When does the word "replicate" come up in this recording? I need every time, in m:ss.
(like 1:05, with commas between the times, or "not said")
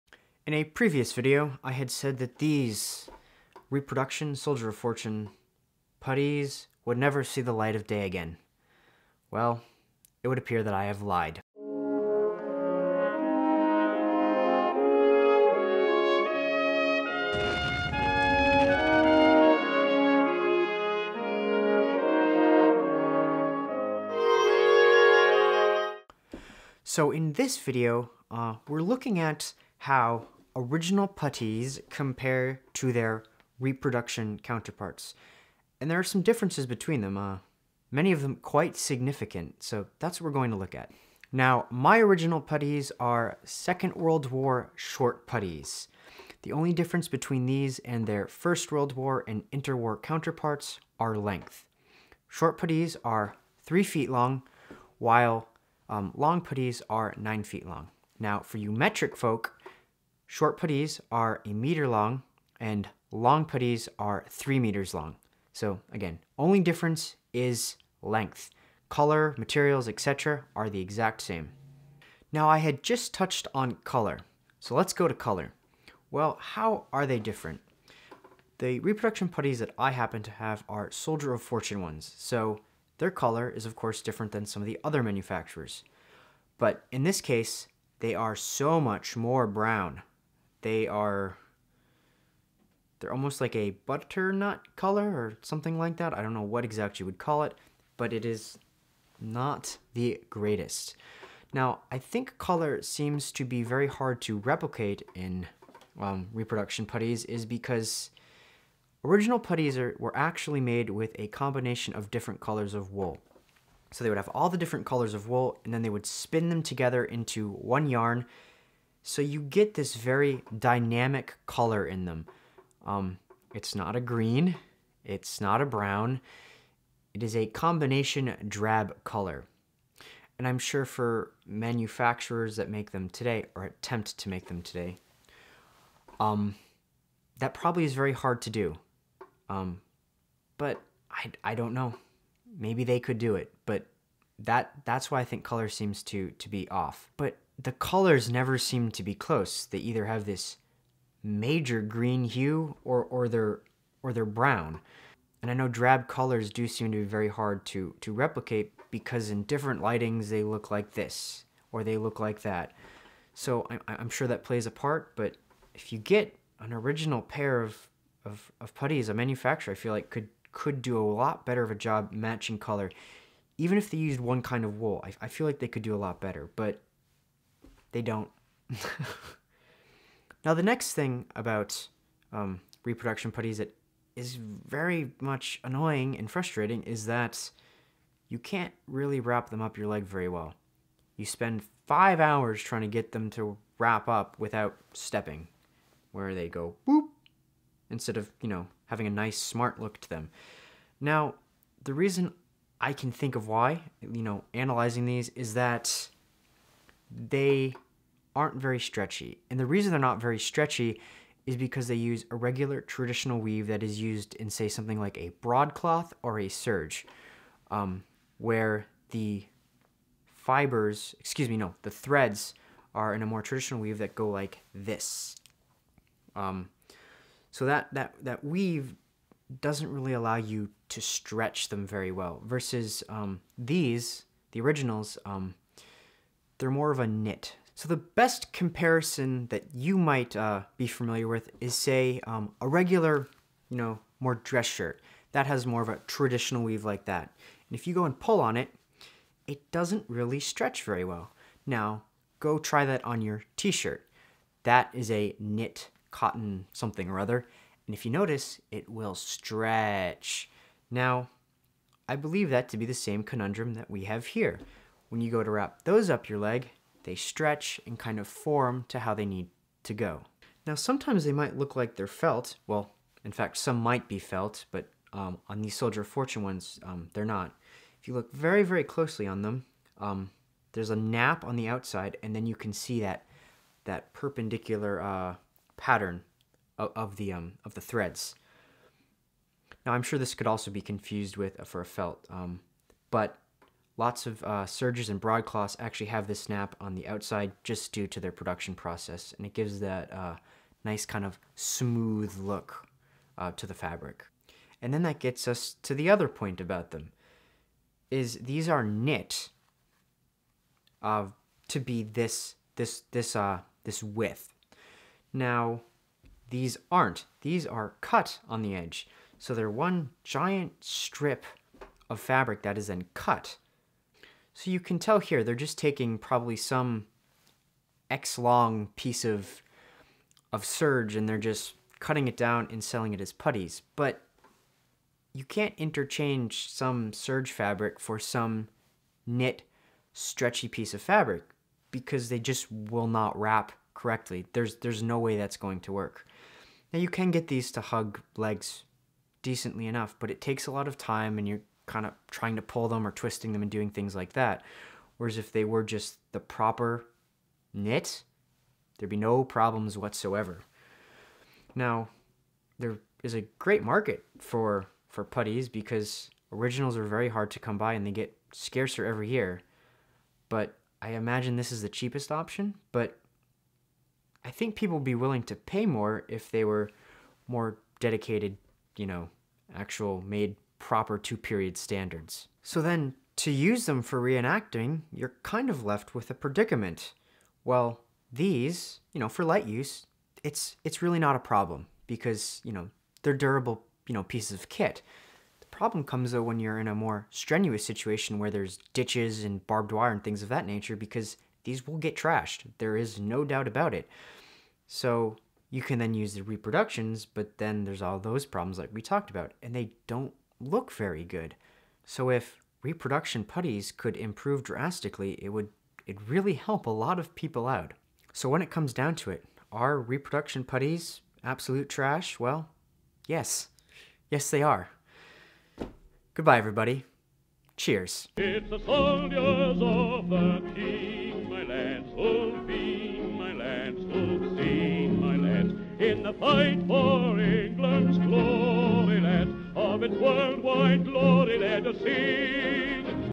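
1:44, 2:38.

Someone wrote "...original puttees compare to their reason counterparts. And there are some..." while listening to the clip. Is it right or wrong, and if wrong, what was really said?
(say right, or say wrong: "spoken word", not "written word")
wrong: "reproduction", not "reason".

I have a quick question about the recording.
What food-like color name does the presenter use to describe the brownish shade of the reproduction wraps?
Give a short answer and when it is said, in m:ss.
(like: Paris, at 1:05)
butternut, at 1:33.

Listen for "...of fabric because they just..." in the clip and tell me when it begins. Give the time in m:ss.
5:40.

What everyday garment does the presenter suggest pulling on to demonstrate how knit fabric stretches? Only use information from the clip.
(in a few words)
t-shirt.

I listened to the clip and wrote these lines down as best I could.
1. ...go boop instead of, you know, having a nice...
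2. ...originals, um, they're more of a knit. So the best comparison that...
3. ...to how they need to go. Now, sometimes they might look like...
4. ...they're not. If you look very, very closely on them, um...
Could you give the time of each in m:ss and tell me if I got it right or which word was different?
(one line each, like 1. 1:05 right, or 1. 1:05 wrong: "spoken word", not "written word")
1. 3:16 right
2. 3:54 right
3. 4:28 right
4. 4:37 right.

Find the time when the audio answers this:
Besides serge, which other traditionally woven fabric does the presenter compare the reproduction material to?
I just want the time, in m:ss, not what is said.
3:35.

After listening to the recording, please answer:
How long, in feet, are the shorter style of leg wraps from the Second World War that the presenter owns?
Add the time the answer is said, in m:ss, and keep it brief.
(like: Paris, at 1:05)
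3 feet, at 0:53.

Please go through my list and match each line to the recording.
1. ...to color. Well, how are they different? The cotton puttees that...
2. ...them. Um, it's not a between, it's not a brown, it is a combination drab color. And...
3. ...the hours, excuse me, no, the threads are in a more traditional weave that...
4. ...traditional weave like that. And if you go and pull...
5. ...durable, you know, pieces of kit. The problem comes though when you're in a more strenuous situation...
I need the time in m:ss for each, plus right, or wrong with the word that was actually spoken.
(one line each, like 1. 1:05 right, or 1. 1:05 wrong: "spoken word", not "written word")
1. 1:15 wrong: "reproduction", not "cotton"
2. 2:02 wrong: "green", not "between"
3. 3:39 wrong: "fibers", not "hours"
4. 4:06 right
5. 6:33 right.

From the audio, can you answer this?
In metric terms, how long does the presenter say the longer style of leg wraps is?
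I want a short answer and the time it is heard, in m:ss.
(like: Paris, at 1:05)
3 meters, at 1:04.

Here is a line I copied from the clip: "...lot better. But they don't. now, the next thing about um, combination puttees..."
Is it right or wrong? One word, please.
wrong.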